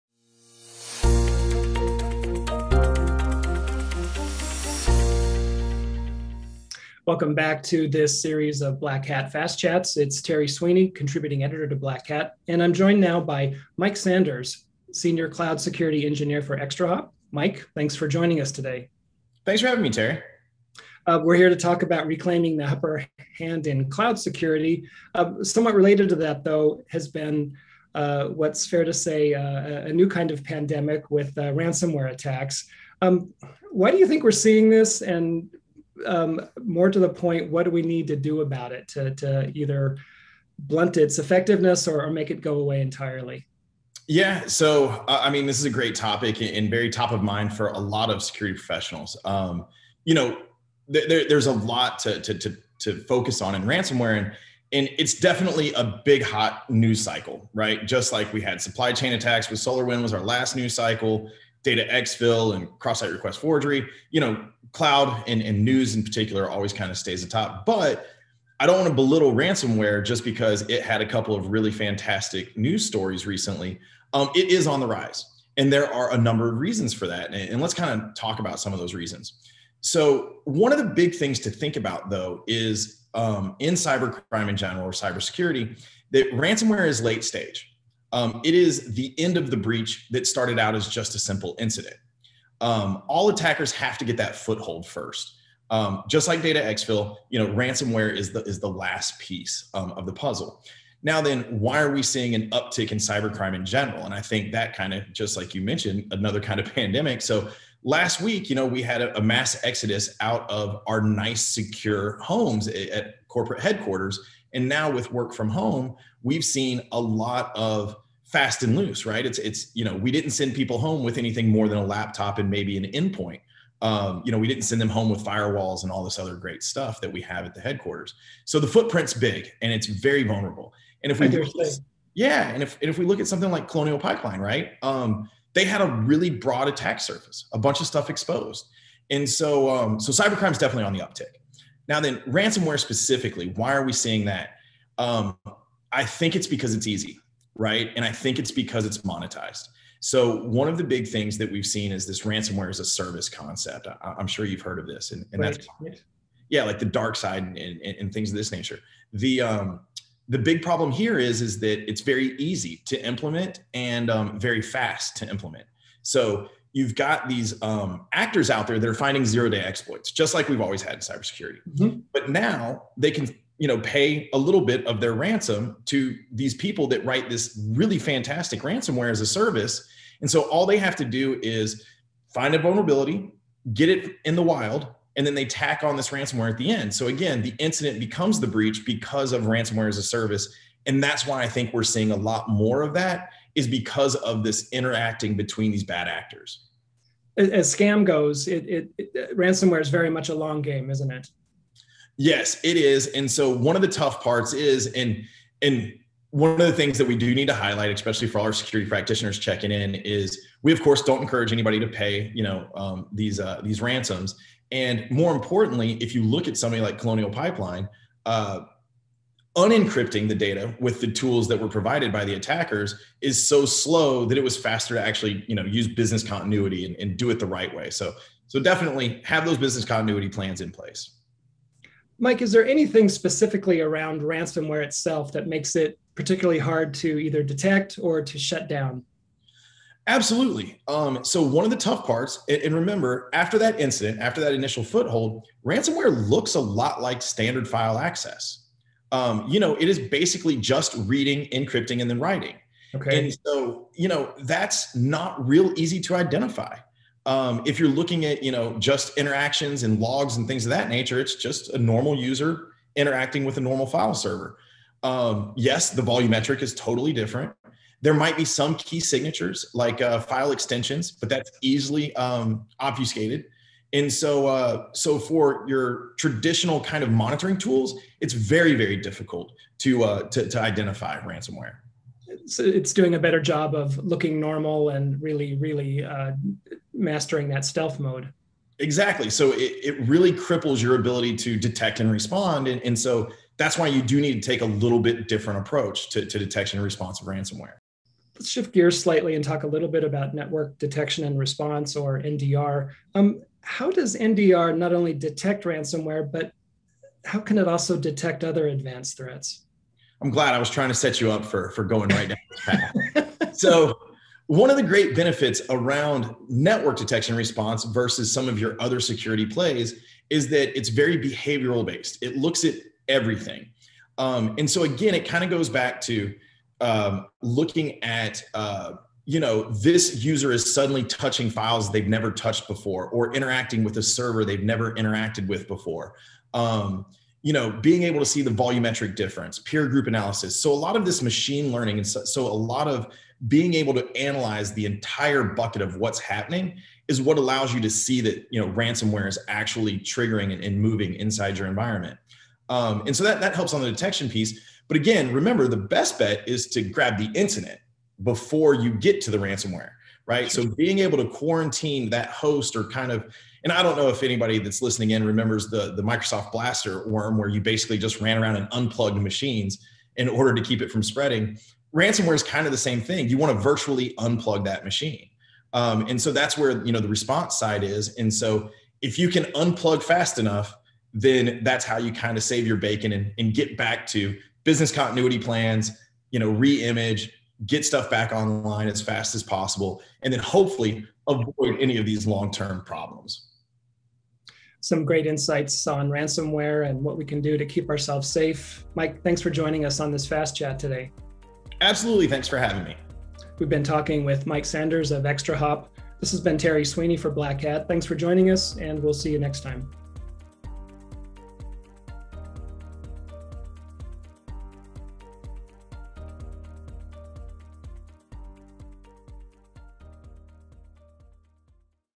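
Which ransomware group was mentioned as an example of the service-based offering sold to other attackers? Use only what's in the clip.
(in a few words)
DarkSide.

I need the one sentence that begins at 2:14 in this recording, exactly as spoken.
Um, they had a really broad attack surface, a bunch of stuff exposed, and so um, so cybercrime's definitely on the uptick.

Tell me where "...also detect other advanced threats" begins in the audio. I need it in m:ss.
5:07.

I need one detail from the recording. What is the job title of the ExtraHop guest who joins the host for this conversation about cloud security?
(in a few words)
Senior cloud security engineer.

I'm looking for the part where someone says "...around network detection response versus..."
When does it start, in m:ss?
5:15.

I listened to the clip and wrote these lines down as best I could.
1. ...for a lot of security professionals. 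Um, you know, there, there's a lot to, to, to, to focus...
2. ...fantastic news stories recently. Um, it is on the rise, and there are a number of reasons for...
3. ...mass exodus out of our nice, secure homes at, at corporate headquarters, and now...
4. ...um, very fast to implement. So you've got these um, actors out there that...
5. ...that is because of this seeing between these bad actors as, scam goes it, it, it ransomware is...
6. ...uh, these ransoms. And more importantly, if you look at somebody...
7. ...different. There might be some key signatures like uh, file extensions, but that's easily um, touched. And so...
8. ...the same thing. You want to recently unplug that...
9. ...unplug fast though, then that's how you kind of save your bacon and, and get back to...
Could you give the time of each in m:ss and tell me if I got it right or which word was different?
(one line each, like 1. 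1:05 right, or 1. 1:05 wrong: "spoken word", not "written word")
1. 0:47 right
2. 1:11 right
3. 1:49 right
4. 2:44 right
5. 3:12 wrong: "interacting", not "seeing"
6. 3:33 right
7. 4:27 wrong: "obfuscated", not "touched"
8. 6:12 wrong: "virtually", not "recently"
9. 6:19 wrong: "enough", not "though".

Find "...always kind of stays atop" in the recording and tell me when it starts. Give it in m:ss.
1:06.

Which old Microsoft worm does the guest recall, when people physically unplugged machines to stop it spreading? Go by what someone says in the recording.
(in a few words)
Blaster.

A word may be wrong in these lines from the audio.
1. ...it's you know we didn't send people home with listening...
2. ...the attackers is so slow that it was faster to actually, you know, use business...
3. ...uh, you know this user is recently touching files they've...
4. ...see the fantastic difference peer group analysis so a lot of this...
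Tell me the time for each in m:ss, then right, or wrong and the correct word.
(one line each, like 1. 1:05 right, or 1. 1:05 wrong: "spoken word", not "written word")
1. 1:59 wrong: "anything", not "listening"
2. 3:42 right
3. 5:28 wrong: "suddenly", not "recently"
4. 5:38 wrong: "volumetric", not "fantastic".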